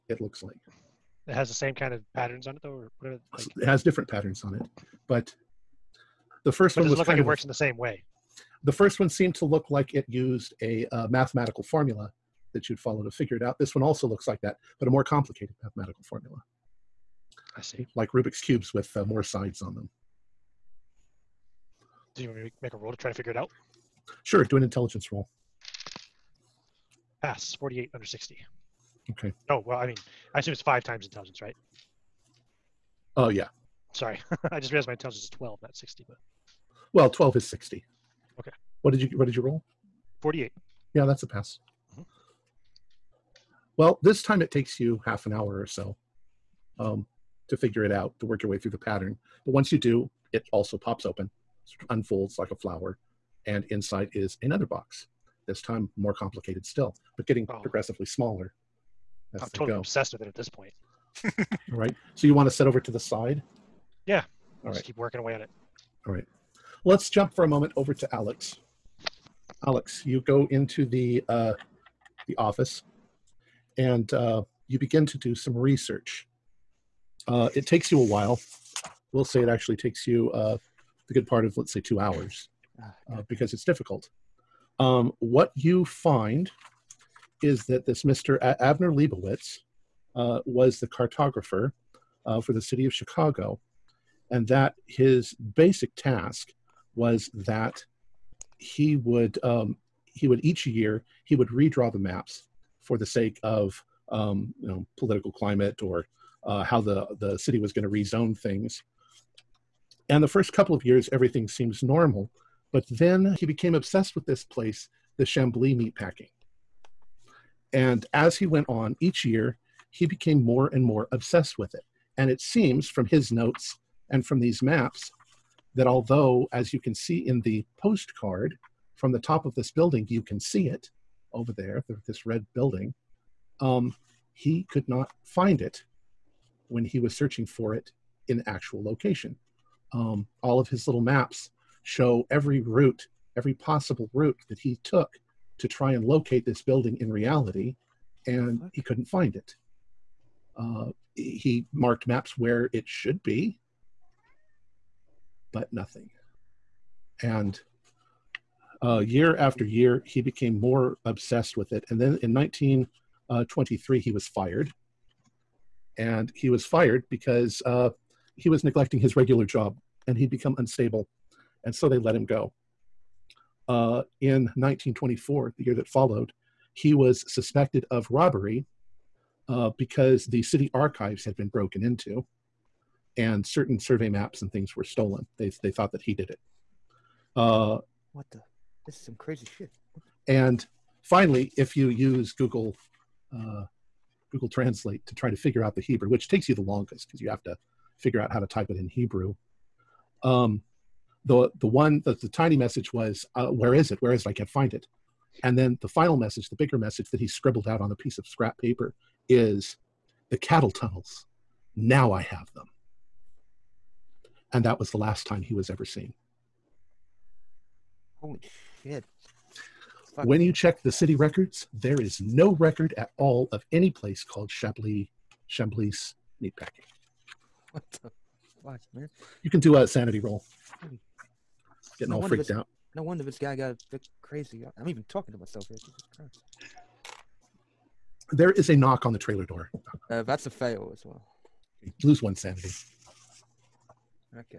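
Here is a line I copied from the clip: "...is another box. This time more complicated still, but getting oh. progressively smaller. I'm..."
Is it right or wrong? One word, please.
right.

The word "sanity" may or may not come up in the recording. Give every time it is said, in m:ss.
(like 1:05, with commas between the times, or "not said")
3:49, 4:02.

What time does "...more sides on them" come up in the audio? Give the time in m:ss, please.
0:19.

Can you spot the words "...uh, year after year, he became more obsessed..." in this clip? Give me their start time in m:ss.
2:38.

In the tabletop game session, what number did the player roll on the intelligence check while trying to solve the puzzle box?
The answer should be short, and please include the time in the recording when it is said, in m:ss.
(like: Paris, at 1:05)
48, at 0:40.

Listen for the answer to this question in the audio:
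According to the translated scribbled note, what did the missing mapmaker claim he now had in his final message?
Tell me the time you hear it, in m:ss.
3:30.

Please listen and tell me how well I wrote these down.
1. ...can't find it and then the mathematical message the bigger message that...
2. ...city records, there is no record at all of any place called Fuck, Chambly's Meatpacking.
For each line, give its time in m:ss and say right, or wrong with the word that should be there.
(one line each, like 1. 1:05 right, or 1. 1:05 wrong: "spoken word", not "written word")
1. 3:24 wrong: "final", not "mathematical"
2. 3:40 wrong: "Chambly", not "Fuck".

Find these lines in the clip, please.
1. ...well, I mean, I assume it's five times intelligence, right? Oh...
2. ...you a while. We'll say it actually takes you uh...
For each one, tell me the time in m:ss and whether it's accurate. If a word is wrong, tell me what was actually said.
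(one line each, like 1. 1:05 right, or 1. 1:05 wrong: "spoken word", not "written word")
1. 0:29 right
2. 1:17 right.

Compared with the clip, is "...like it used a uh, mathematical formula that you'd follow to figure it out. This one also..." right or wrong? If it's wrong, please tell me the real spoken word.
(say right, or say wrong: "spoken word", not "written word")
right.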